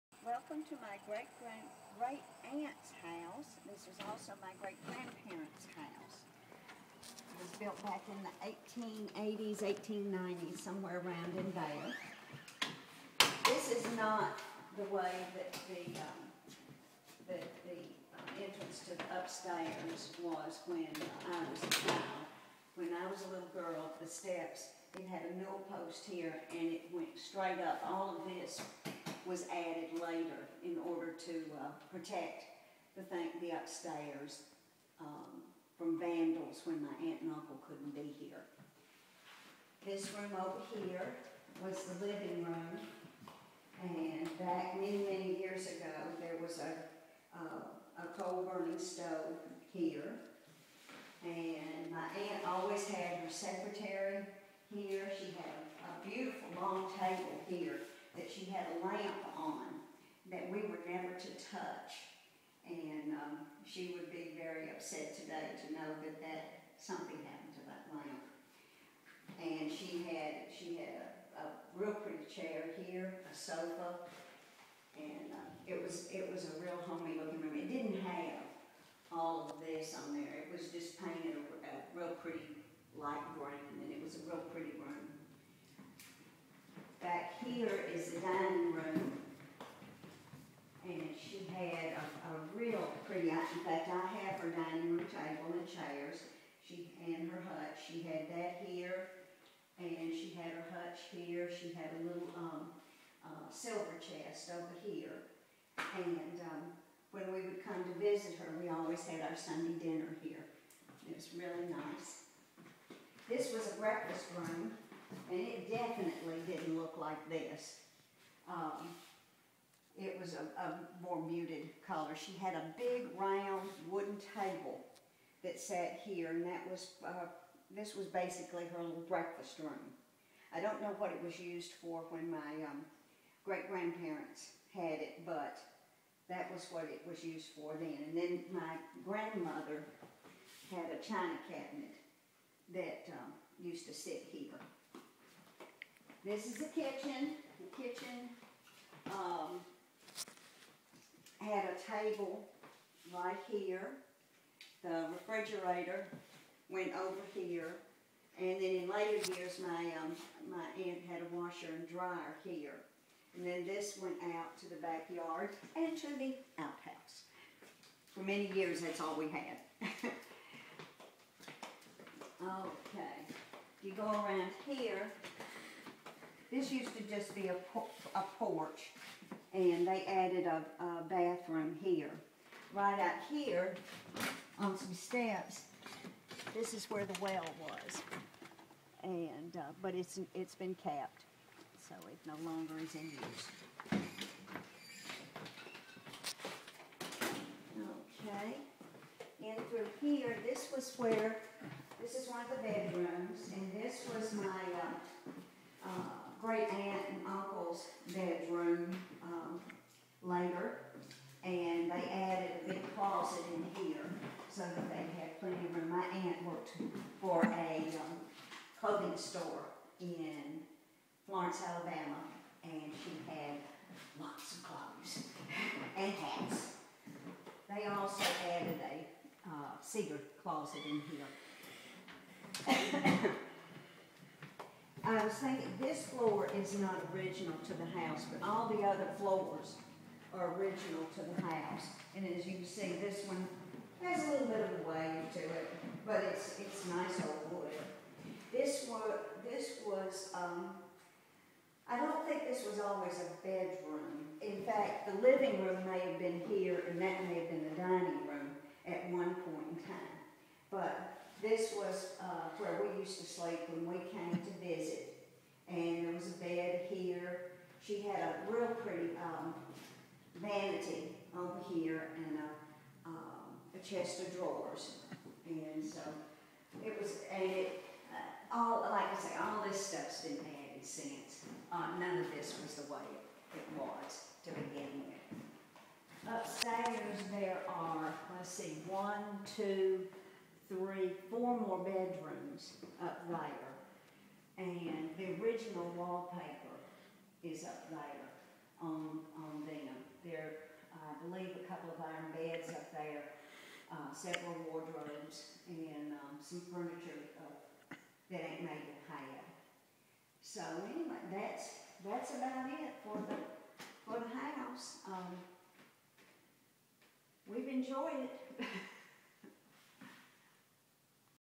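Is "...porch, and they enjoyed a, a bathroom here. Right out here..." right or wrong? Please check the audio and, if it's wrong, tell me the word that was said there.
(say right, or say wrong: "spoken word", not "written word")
wrong: "added", not "enjoyed".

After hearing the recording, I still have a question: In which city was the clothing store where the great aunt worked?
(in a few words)
Florence, Alabama.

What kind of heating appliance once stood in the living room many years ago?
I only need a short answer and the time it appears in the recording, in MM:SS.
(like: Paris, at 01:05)
coal-burning stove, at 00:48.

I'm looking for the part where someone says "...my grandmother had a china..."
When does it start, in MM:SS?
02:18.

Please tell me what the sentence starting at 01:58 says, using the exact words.
Um, it was a, a more muted color.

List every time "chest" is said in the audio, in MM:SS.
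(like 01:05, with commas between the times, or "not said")
01:43, 04:33.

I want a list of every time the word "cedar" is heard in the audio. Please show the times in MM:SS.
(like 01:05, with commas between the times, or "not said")
03:49.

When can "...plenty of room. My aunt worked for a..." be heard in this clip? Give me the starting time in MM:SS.
03:35.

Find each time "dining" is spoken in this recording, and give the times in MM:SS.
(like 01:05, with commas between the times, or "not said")
01:28, 01:34, 04:17.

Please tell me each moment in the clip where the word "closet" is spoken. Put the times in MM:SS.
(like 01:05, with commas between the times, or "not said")
03:32, 03:50.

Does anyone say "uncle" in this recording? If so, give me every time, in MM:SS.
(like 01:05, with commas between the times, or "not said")
00:37, 03:27.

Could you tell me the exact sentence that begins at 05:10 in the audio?
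So anyway, that's, that's about it for the, for the house.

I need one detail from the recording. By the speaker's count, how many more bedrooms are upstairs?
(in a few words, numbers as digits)
4.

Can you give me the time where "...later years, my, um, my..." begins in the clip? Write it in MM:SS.
02:38.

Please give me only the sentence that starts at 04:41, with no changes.
Uh, none of this was the way it, it was to begin with.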